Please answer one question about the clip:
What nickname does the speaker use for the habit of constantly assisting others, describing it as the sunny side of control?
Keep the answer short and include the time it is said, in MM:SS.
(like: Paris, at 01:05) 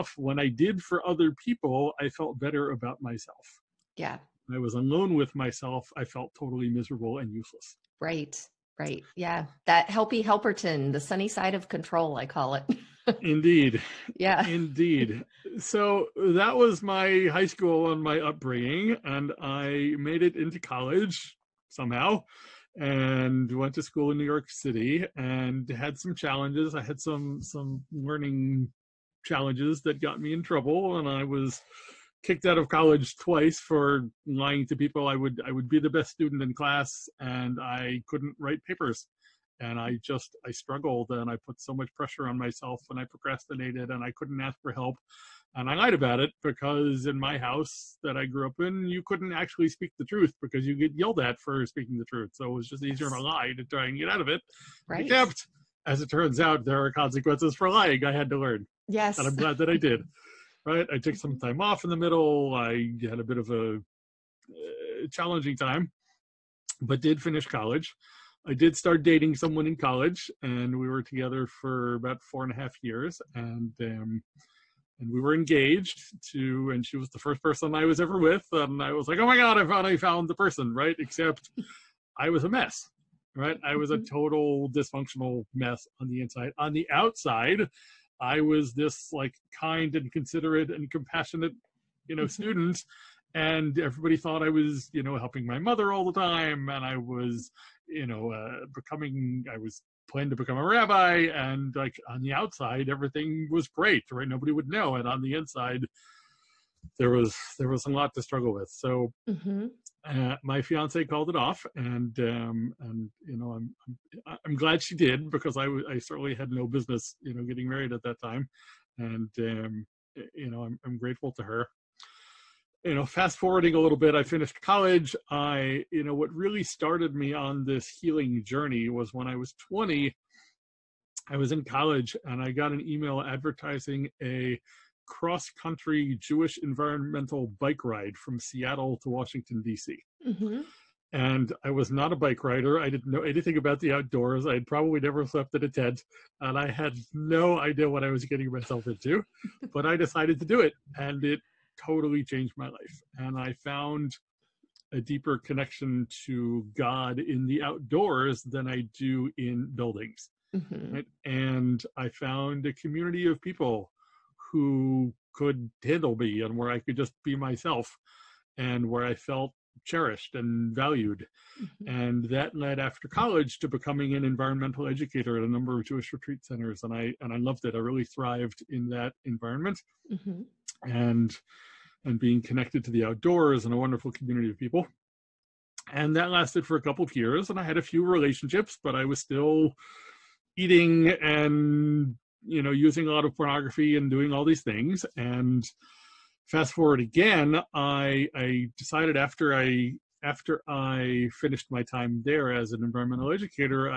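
Helpy Helperton, at 00:09.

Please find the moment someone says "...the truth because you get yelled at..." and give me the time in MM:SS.
00:49.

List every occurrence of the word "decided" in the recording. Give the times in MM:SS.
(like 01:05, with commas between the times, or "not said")
02:29, 03:18.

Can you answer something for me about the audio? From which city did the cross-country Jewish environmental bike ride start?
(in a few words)
Seattle.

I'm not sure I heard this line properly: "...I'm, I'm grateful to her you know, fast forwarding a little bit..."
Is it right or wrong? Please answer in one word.
right.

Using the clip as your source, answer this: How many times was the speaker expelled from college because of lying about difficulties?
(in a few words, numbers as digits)
2.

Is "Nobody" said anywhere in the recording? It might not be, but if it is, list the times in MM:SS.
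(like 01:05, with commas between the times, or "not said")
01:44.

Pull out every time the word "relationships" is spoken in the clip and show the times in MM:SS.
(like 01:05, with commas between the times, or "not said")
03:08.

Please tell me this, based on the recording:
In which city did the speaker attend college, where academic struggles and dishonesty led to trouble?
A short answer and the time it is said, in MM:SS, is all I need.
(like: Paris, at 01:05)
New York City, at 00:24.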